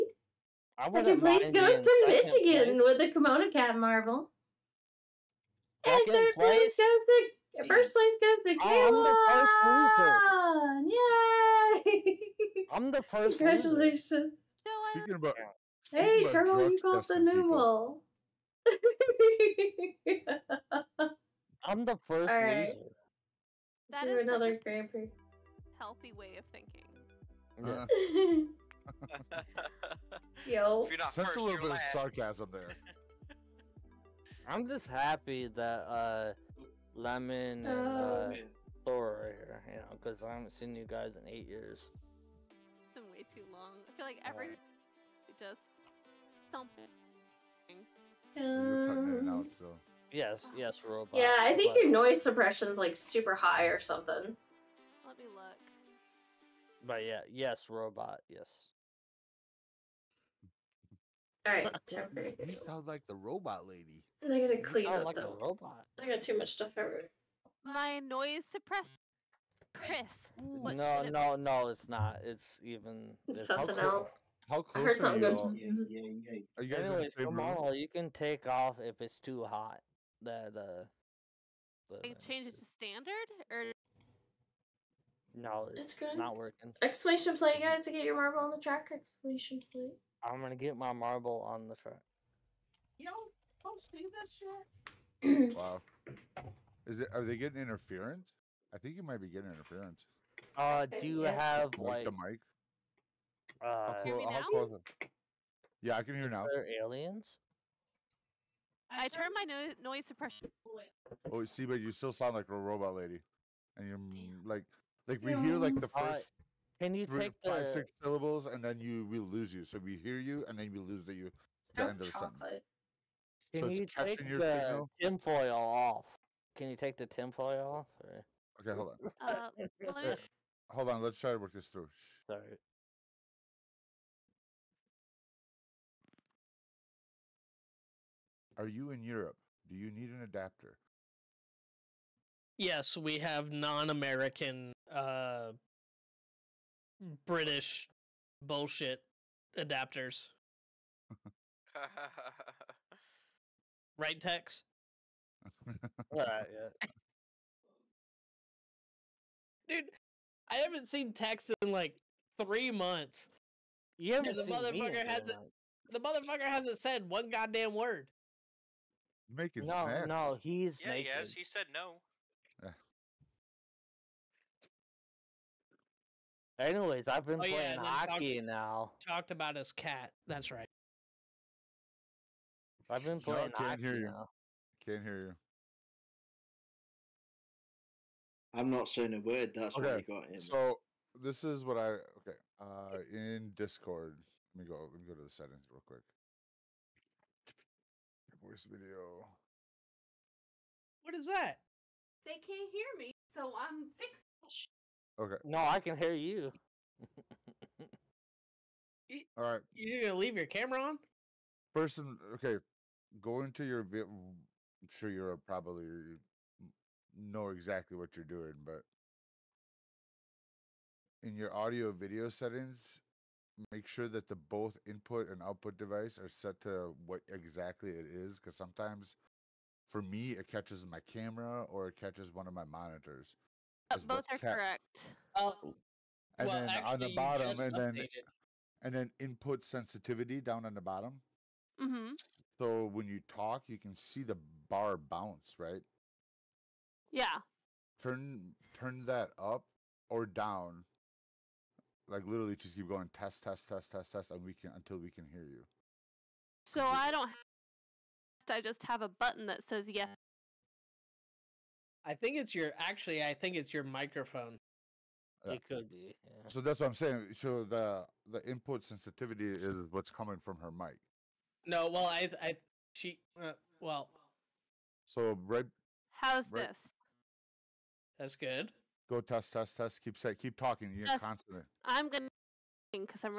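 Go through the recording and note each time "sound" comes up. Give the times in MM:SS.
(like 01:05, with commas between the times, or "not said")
01:02, 01:52.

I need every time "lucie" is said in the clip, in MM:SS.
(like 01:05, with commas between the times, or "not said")
not said.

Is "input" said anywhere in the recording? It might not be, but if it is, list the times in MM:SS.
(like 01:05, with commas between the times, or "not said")
03:44, 03:59, 04:28.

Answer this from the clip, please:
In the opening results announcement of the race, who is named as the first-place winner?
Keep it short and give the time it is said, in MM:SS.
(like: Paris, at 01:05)
Kayla, at 00:08.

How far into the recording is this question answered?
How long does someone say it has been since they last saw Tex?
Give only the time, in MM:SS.
02:42.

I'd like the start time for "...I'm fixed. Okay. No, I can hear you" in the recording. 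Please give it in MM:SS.
03:23.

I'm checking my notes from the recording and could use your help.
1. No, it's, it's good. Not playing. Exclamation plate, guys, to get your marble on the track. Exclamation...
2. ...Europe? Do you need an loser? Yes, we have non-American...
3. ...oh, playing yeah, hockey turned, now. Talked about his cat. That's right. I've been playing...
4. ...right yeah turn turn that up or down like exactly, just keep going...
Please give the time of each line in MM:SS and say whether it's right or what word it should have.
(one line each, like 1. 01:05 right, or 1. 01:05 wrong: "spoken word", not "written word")
1. 01:25 wrong: "working", not "playing"
2. 02:19 wrong: "adapter", not "loser"
3. 02:57 wrong: "talked", not "turned"
4. 04:05 wrong: "literally", not "exactly".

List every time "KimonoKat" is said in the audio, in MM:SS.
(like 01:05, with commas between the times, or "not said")
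00:03.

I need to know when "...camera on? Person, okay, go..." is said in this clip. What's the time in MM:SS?
03:30.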